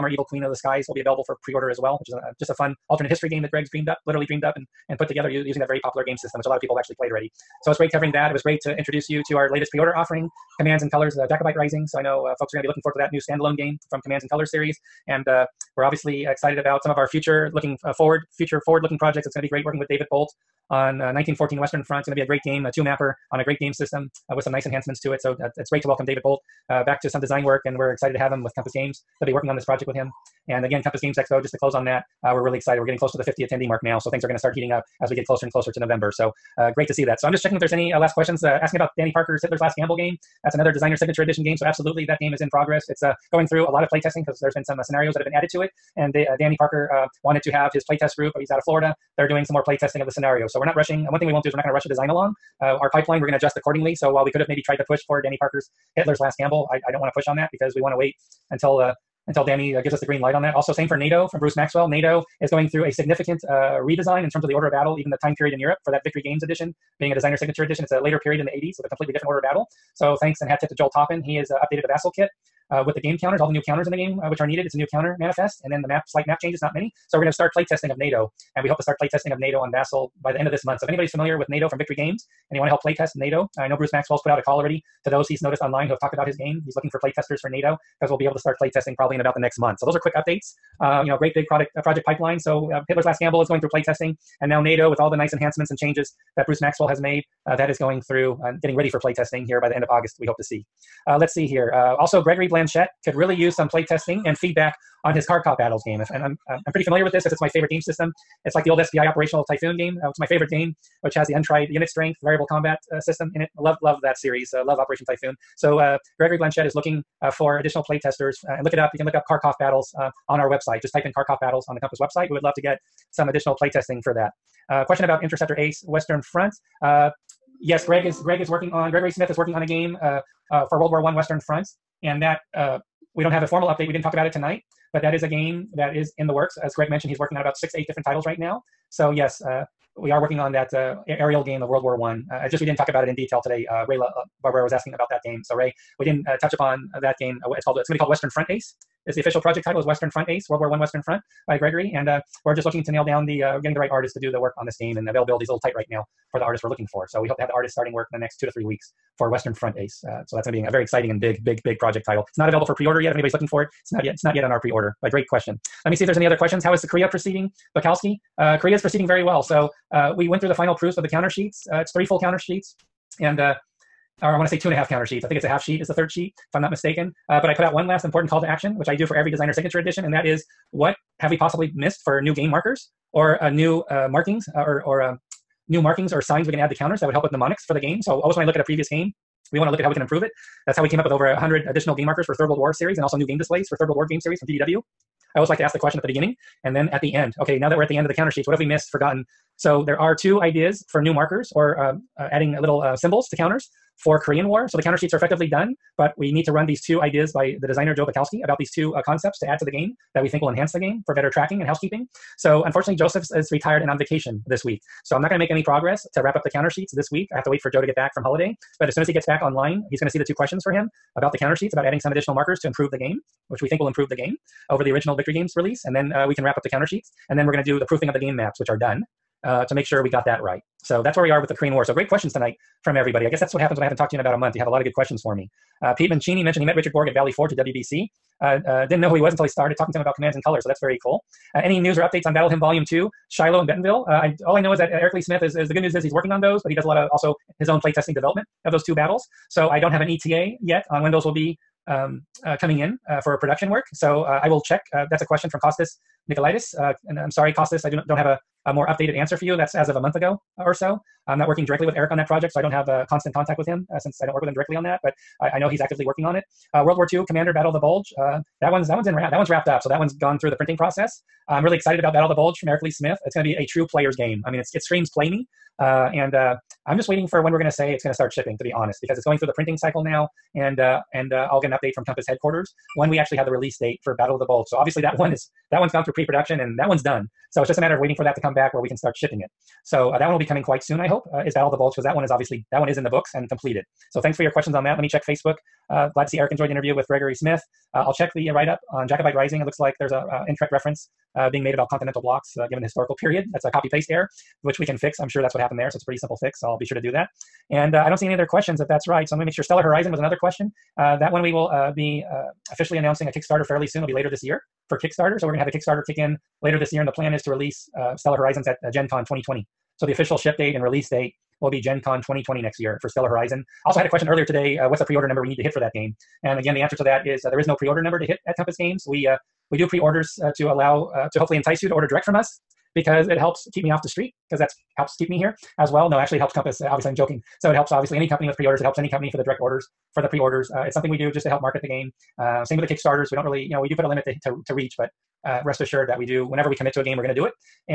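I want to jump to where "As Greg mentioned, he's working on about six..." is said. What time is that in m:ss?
2:16.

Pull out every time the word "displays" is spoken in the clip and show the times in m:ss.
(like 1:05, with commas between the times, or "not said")
3:13.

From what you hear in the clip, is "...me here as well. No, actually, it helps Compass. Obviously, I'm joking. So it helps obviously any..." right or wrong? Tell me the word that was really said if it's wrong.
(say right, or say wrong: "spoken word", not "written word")
right.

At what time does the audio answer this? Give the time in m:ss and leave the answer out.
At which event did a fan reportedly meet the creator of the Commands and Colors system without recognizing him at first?
3:57.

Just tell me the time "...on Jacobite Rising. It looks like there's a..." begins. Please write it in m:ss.
4:58.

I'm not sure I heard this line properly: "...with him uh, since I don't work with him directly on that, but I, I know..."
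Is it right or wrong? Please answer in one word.
right.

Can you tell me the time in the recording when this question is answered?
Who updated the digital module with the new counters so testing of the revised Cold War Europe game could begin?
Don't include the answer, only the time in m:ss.
1:10.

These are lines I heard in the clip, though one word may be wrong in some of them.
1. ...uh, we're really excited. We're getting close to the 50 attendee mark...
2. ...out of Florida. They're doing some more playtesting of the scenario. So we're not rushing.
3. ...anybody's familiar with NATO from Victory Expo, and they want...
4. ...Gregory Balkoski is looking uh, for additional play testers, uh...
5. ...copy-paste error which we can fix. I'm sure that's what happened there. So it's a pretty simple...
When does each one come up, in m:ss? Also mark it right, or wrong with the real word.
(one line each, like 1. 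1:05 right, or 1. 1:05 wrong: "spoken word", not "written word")
1. 0:32 right
2. 0:48 right
3. 1:20 wrong: "Games", not "Expo"
4. 1:56 wrong: "Blanchette", not "Balkoski"
5. 5:03 right.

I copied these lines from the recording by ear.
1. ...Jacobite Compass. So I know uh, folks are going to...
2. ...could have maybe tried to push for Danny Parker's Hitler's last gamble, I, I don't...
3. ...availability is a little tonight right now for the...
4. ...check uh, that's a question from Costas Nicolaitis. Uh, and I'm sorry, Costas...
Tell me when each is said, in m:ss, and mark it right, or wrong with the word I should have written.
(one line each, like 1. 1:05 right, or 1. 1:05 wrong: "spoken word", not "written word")
1. 0:11 wrong: "Rising", not "Compass"
2. 0:54 right
3. 2:35 wrong: "tight", not "tonight"
4. 4:14 right.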